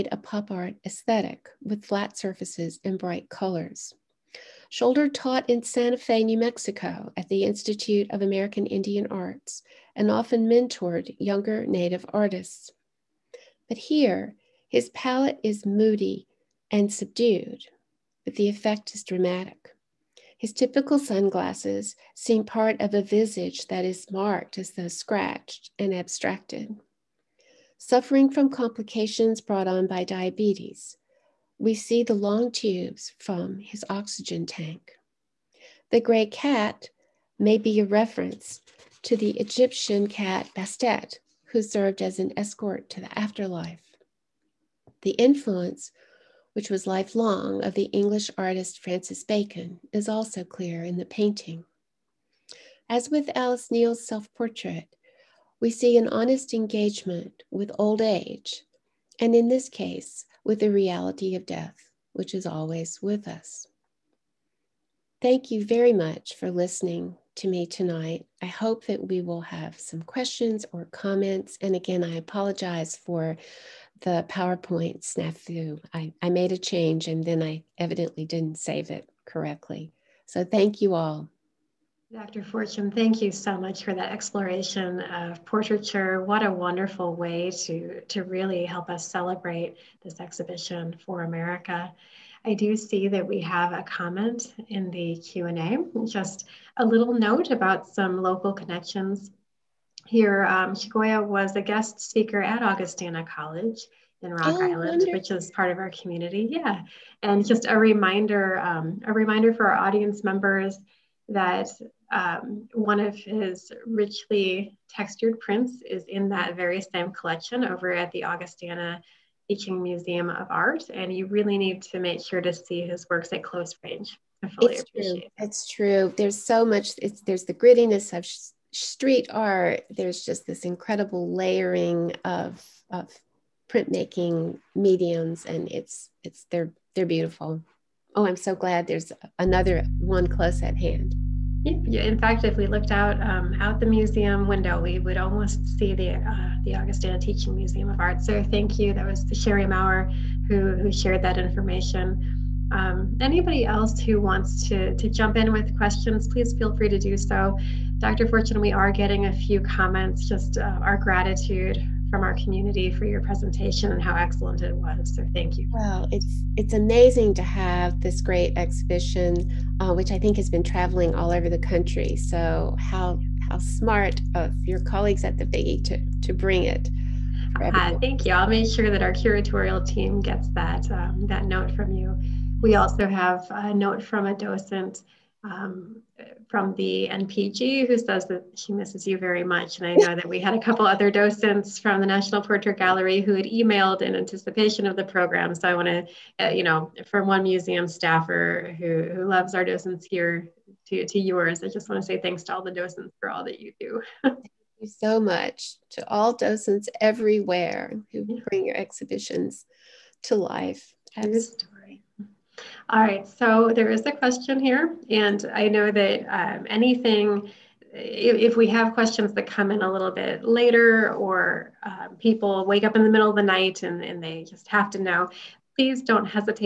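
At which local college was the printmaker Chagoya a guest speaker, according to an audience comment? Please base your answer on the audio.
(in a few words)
Augustana College.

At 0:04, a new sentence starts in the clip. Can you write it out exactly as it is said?
Scholder taught in Santa Fe, New Mexico at the Institute of American Indian Arts and often mentored younger Native artists.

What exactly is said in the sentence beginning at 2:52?
So how how smart of your colleagues at the Figge to to bring it.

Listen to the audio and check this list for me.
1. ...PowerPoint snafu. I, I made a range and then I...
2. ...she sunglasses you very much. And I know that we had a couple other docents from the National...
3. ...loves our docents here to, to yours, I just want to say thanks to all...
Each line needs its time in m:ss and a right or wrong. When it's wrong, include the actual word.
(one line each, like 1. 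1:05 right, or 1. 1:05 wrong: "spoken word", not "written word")
1. 1:14 wrong: "change", not "range"
2. 3:08 wrong: "misses", not "sunglasses"
3. 3:19 right.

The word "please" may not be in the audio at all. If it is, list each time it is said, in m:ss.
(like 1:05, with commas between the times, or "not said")
2:36, 3:45.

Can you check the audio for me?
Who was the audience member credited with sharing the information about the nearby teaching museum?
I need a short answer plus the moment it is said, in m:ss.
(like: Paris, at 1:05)
Sherry Maurer, at 2:29.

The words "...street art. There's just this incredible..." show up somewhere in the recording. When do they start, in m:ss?
2:08.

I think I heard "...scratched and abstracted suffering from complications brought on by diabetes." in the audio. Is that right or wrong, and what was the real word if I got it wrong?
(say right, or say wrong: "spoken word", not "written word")
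right.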